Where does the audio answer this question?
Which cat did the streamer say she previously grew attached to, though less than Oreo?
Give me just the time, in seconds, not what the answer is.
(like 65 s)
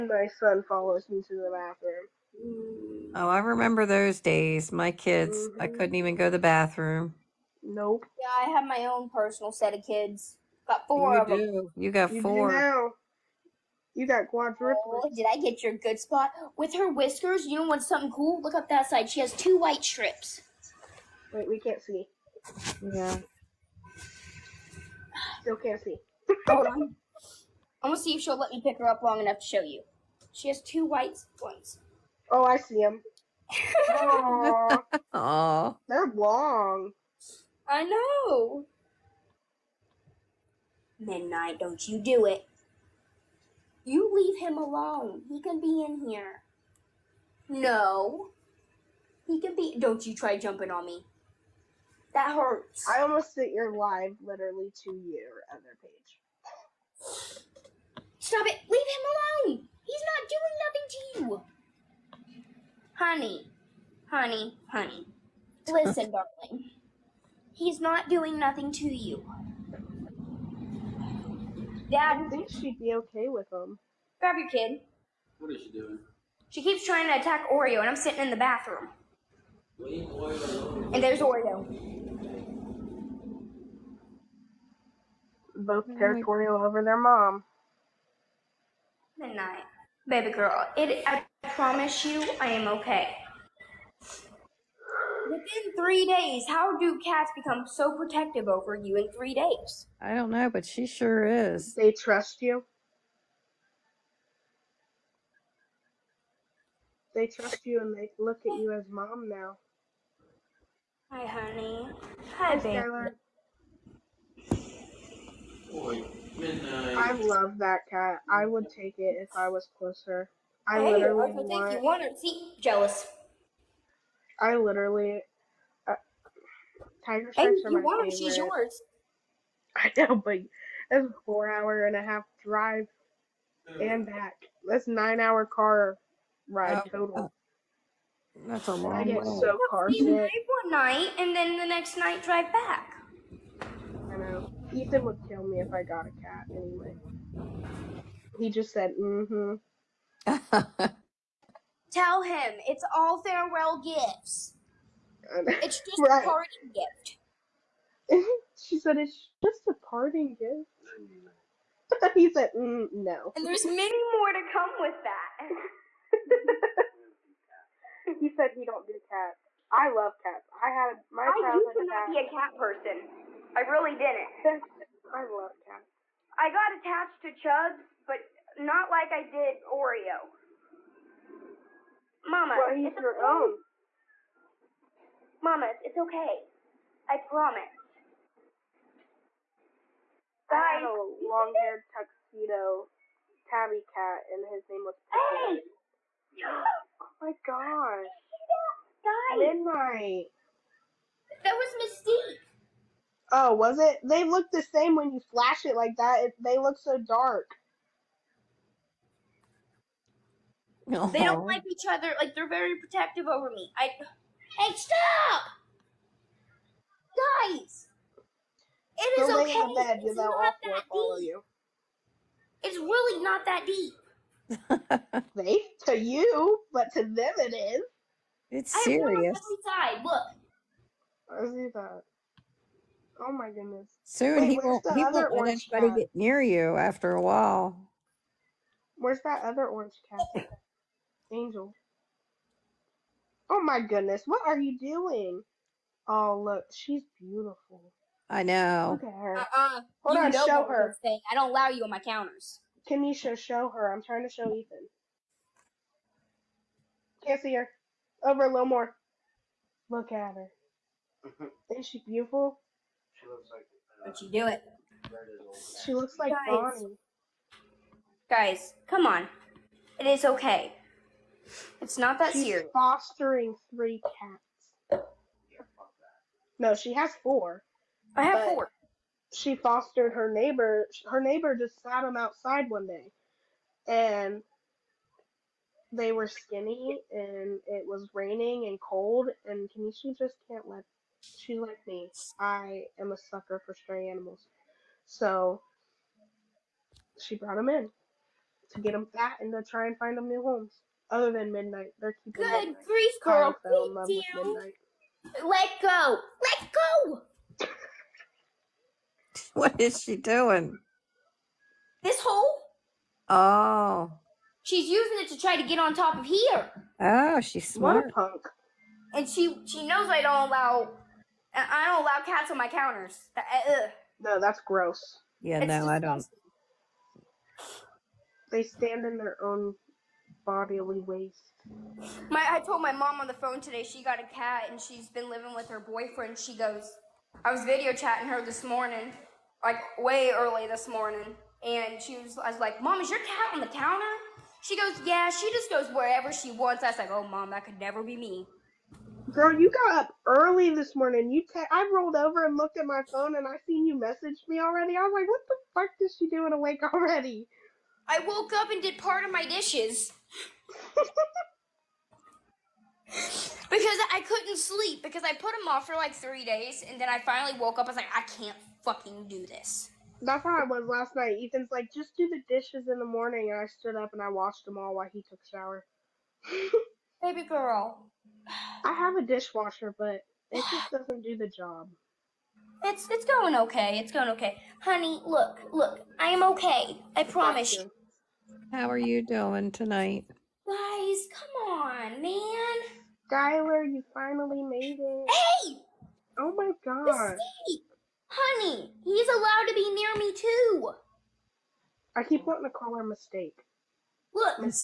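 177 s.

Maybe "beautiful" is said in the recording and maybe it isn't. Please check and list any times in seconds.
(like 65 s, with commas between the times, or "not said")
247 s, 262 s.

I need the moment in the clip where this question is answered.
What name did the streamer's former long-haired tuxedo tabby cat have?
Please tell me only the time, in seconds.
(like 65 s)
195 s.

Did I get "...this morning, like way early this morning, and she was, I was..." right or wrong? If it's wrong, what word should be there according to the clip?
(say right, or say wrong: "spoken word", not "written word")
right.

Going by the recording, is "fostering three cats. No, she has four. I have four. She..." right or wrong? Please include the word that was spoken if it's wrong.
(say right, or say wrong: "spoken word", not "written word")
right.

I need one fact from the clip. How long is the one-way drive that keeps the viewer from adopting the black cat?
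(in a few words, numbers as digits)
4 and a half hours.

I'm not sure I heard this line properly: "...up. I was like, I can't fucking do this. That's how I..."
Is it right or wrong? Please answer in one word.
right.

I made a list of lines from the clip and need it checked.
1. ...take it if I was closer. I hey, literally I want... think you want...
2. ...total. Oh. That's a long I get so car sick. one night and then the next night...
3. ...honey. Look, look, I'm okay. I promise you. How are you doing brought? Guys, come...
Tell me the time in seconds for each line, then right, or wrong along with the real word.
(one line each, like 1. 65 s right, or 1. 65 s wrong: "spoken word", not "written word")
1. 118 s right
2. 136 s right
3. 384 s wrong: "tonight", not "brought".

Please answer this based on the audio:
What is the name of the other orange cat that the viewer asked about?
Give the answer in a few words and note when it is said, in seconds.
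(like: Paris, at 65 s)
Angel, at 241 s.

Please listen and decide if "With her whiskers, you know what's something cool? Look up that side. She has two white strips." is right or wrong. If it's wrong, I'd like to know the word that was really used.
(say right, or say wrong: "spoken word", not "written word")
right.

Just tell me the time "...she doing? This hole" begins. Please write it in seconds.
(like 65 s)
310 s.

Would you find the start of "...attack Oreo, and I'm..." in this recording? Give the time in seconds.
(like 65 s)
77 s.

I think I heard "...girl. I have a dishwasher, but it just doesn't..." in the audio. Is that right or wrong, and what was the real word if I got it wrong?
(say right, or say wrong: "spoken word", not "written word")
right.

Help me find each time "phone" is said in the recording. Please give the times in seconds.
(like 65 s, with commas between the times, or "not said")
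333 s, 353 s.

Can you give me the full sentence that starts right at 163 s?
And there's many more to come with that.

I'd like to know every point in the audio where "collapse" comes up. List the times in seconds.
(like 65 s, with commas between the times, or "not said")
not said.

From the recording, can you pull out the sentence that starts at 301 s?
Other than midnight, they're keeping good midnight.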